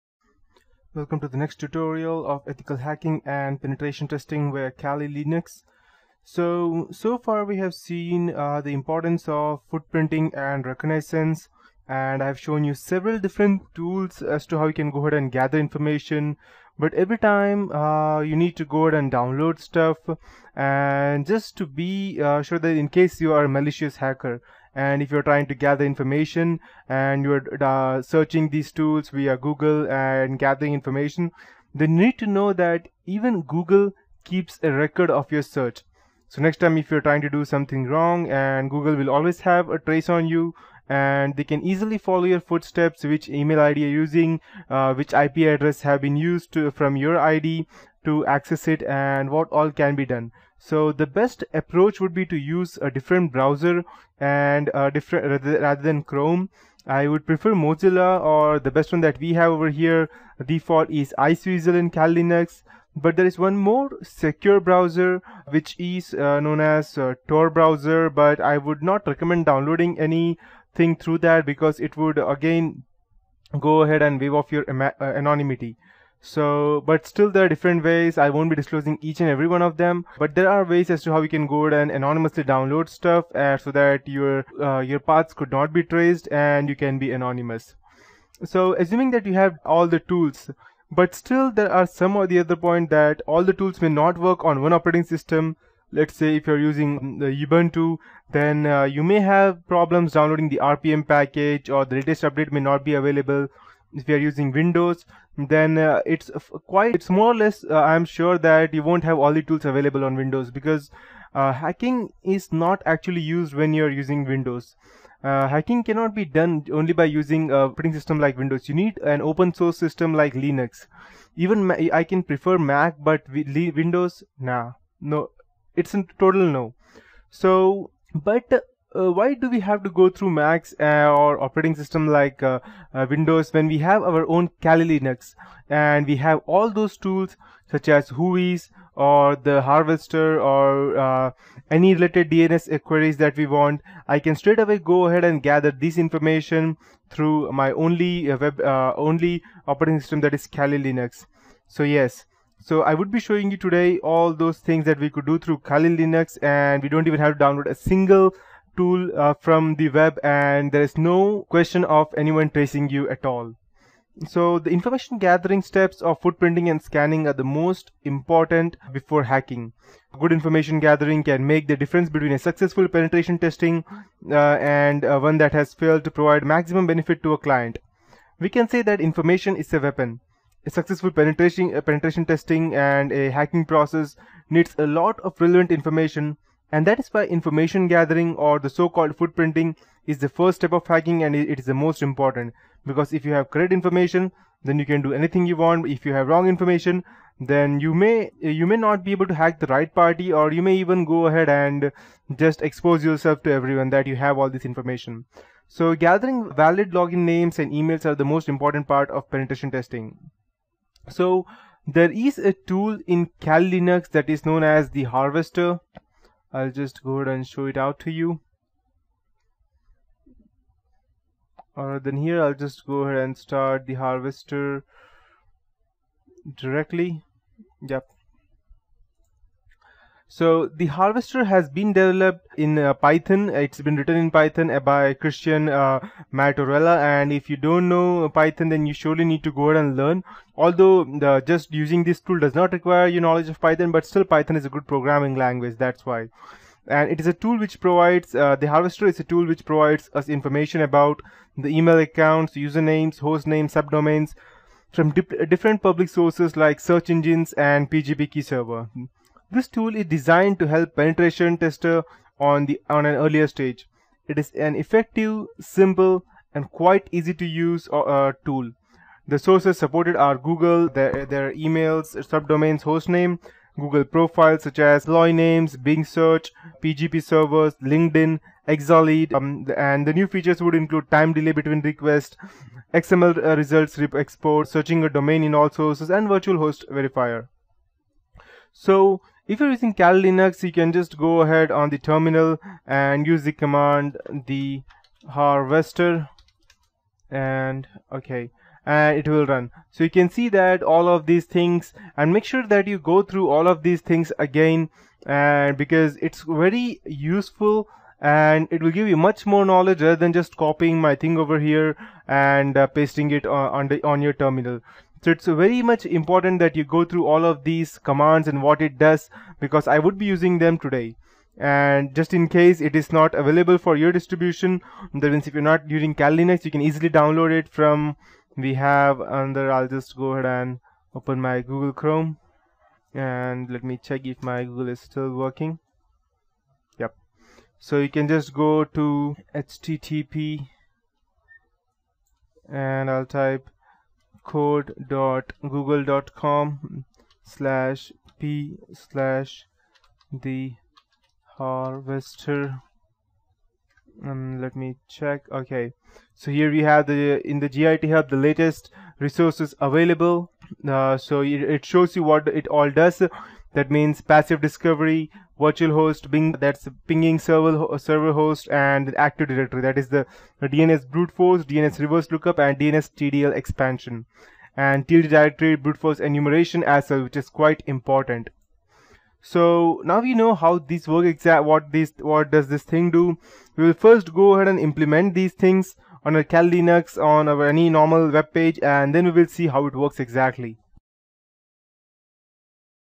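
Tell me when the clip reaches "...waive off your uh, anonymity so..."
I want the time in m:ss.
1:14.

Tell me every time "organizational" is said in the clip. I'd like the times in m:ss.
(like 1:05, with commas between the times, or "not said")
not said.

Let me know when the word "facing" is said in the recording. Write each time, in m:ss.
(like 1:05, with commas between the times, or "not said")
not said.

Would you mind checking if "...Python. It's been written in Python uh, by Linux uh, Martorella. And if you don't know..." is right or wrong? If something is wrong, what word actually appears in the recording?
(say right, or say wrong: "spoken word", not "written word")
wrong: "Christian", not "Linux".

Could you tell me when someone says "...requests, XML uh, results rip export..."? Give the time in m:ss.
4:41.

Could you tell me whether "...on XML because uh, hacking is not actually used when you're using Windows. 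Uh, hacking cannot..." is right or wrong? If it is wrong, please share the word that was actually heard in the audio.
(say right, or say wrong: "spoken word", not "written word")
wrong: "Windows", not "XML".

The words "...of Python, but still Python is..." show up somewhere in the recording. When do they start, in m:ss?
4:03.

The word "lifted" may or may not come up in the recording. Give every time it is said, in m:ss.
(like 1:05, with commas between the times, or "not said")
not said.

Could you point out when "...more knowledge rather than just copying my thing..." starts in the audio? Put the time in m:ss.
5:09.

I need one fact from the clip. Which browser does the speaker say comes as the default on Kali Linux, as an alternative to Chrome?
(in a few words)
Iceweasel.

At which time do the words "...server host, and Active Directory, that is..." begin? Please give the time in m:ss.
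6:07.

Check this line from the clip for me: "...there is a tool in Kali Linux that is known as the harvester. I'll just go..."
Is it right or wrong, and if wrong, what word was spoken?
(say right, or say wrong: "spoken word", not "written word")
right.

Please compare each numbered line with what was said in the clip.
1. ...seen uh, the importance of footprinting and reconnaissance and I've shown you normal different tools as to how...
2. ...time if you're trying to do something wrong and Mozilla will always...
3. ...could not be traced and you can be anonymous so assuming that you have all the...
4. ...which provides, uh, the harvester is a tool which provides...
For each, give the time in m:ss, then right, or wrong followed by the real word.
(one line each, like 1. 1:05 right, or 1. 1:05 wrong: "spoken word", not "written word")
1. 0:07 wrong: "several", not "normal"
2. 0:36 wrong: "Google", not "Mozilla"
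3. 1:25 right
4. 4:07 right.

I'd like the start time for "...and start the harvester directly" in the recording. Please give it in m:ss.
3:43.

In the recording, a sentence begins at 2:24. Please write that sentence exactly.
I can straight away go ahead and gather this information through my only uh, web only operating system that is Kali Linux.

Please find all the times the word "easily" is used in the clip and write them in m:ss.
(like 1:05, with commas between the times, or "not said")
0:41, 5:26.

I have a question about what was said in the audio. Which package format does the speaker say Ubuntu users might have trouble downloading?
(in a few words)
RPM.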